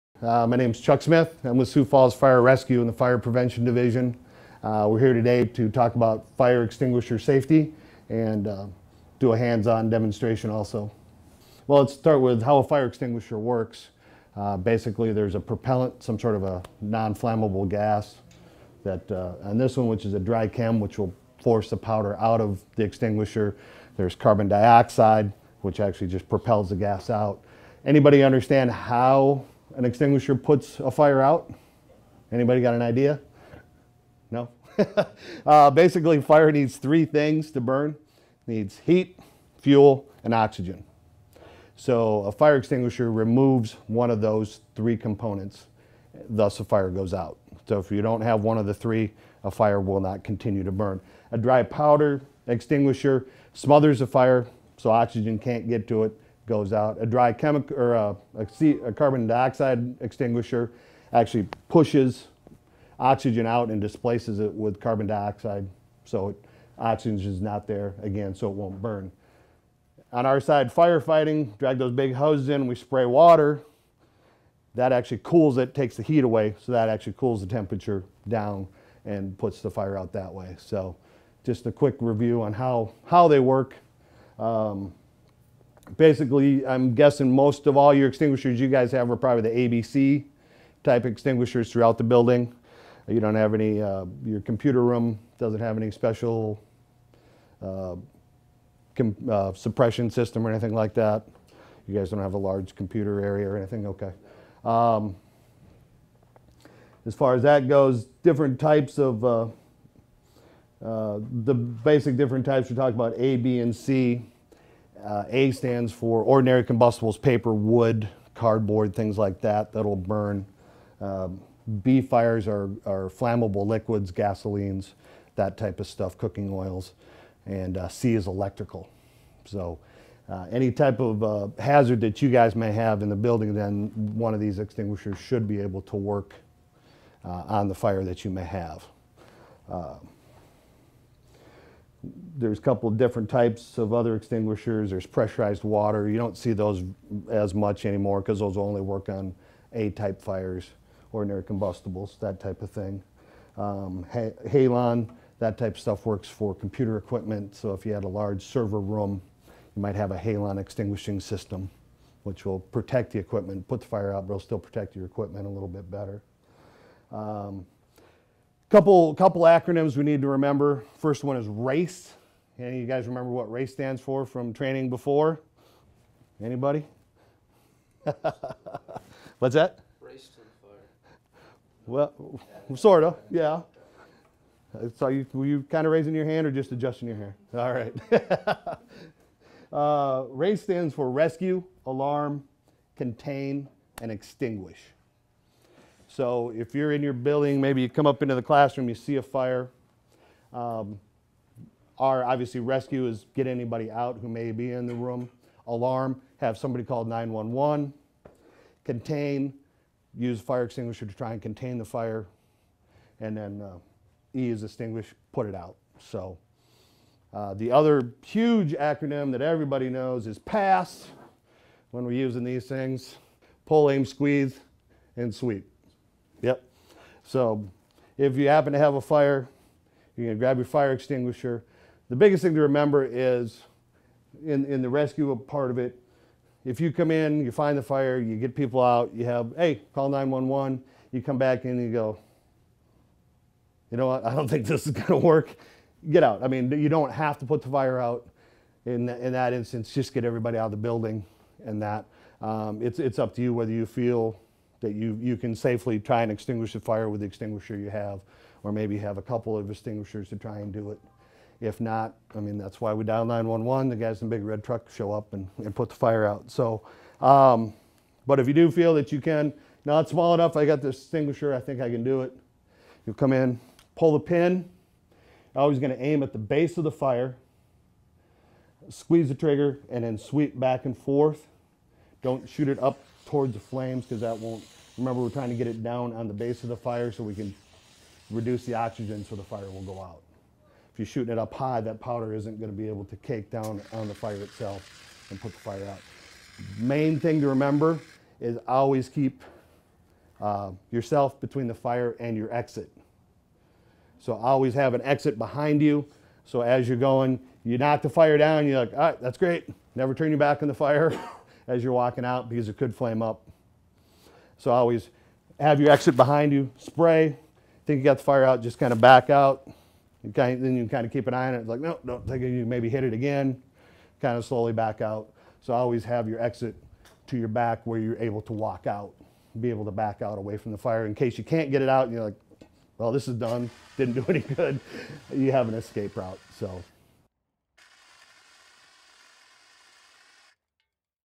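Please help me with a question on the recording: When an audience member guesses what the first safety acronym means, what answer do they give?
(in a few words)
Race to the fire.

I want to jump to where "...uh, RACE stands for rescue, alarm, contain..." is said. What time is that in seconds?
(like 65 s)
189 s.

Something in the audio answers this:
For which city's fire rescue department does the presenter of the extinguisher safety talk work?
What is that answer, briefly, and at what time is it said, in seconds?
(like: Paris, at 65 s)
Sioux Falls, at 1 s.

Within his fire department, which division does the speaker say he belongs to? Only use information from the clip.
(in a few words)
Fire Prevention Division.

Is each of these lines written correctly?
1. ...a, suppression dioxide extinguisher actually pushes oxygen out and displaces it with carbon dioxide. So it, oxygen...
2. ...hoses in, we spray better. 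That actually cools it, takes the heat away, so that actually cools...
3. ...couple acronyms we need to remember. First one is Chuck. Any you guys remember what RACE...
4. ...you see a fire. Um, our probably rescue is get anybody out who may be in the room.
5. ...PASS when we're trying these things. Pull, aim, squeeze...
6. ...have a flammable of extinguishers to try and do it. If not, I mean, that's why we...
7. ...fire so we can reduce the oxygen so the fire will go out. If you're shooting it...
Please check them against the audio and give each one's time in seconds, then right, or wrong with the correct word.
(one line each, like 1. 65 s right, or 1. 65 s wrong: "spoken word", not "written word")
1. 57 s wrong: "carbon", not "suppression"
2. 72 s wrong: "water", not "better"
3. 169 s wrong: "RACE", not "Chuck"
4. 198 s wrong: "obviously", not "probably"
5. 220 s wrong: "using", not "trying"
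6. 258 s wrong: "couple", not "flammable"
7. 286 s right.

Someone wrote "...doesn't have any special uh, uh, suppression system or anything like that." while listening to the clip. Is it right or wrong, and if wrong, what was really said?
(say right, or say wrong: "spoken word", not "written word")
right.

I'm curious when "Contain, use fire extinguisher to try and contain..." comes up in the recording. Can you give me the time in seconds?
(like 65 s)
208 s.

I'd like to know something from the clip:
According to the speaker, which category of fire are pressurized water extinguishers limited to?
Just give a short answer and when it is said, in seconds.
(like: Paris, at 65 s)
A-type fires, at 149 s.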